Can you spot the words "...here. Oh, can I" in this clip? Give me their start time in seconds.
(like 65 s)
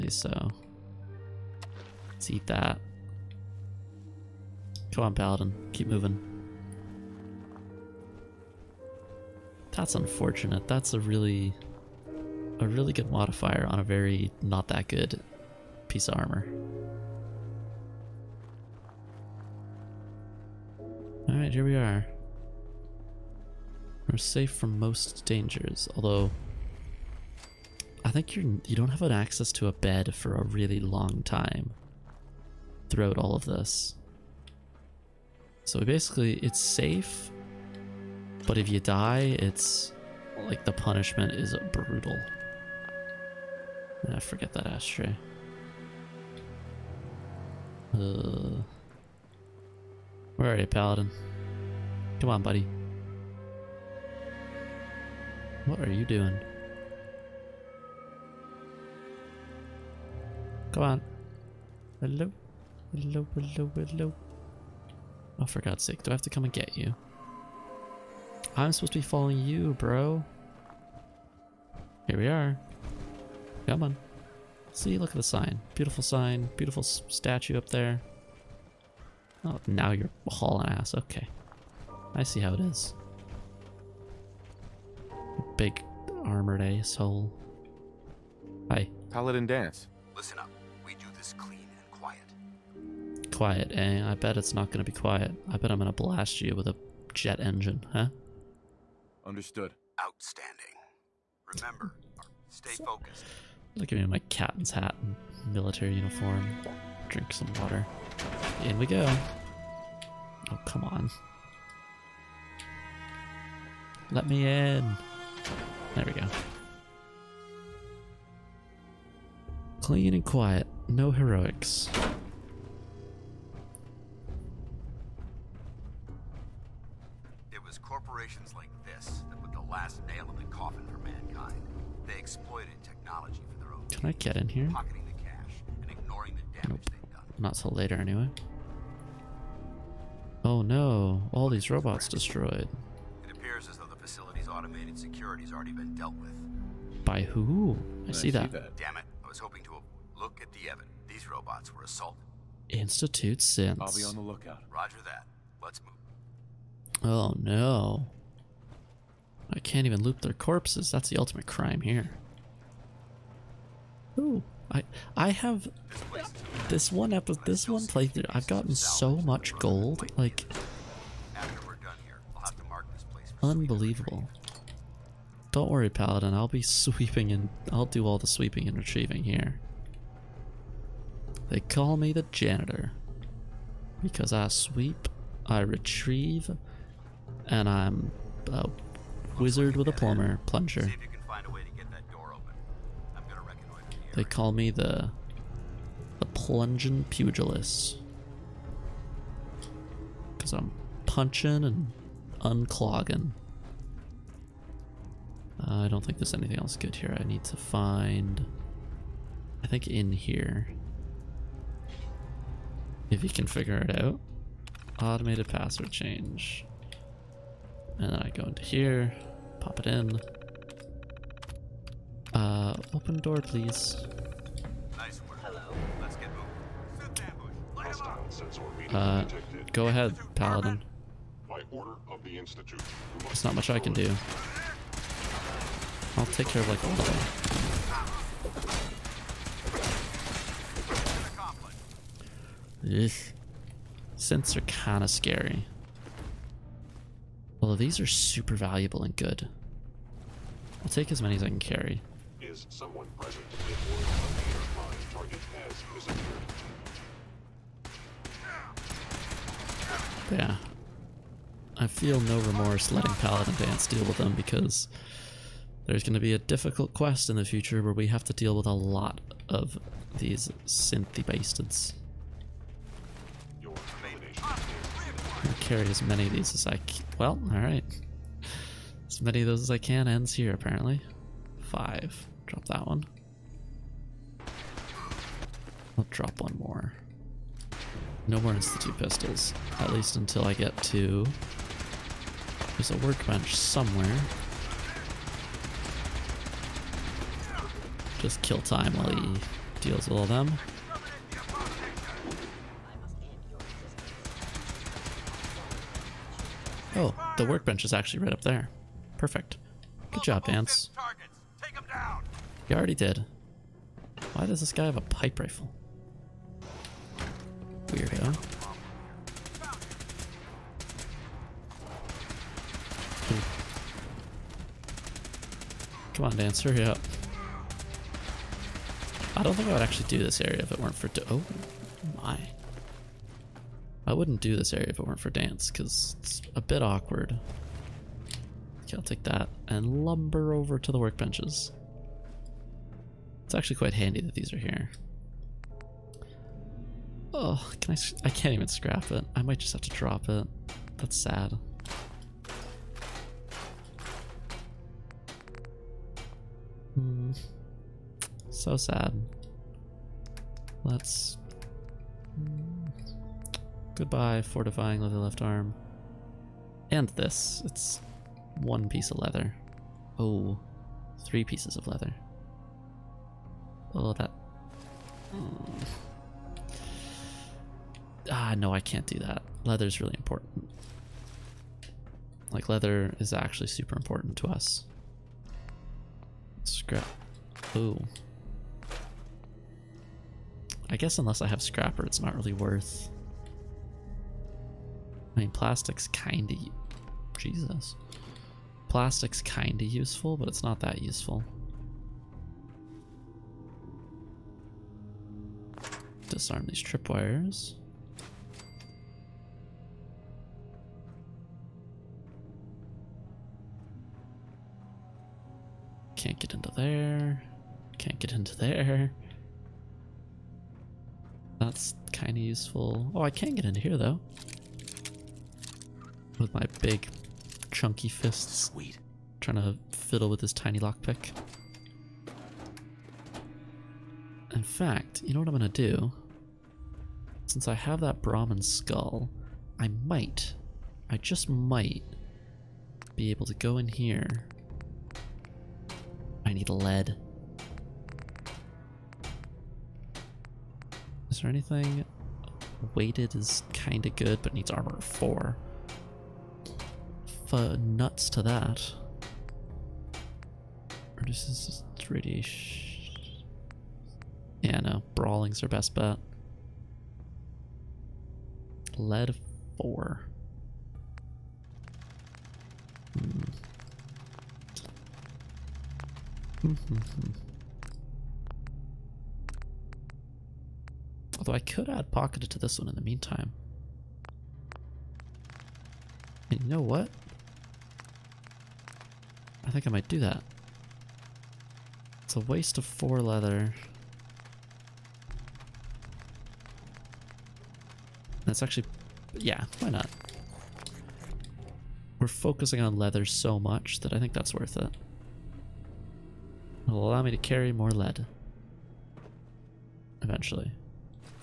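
344 s.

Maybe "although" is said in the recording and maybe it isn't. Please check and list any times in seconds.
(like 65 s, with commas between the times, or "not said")
25 s, 247 s, 481 s.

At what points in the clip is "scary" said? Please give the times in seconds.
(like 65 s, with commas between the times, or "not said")
245 s.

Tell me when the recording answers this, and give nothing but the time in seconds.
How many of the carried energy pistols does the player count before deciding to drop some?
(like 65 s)
281 s.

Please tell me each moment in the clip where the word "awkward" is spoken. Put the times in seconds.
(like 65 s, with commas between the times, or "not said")
336 s.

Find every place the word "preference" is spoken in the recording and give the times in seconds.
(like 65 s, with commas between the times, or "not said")
not said.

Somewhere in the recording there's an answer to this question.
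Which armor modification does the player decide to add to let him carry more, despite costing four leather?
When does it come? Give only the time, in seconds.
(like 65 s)
482 s.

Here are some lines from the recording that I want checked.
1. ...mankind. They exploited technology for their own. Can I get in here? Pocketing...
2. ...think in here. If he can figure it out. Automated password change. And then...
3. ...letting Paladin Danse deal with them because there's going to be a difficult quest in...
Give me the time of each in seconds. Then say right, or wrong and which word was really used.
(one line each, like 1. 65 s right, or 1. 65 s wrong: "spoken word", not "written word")
1. 130 s right
2. 209 s right
3. 262 s right.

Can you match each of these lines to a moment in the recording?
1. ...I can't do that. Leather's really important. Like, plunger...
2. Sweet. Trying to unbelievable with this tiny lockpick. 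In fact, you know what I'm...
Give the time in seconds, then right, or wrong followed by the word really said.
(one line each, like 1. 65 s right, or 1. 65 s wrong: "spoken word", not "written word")
1. 378 s wrong: "leather", not "plunger"
2. 428 s wrong: "fiddle", not "unbelievable".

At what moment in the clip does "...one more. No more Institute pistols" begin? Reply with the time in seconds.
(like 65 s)
286 s.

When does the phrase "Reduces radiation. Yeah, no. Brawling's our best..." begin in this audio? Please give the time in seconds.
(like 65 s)
461 s.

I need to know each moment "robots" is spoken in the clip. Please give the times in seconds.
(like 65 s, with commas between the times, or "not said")
141 s, 151 s.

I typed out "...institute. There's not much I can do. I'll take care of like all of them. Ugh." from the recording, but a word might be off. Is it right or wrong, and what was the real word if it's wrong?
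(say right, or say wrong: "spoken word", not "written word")
right.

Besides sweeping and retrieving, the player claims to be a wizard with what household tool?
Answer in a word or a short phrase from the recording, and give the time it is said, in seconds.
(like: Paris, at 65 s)
a plumber plunger, at 189 s.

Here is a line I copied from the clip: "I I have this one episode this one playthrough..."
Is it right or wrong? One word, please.
right.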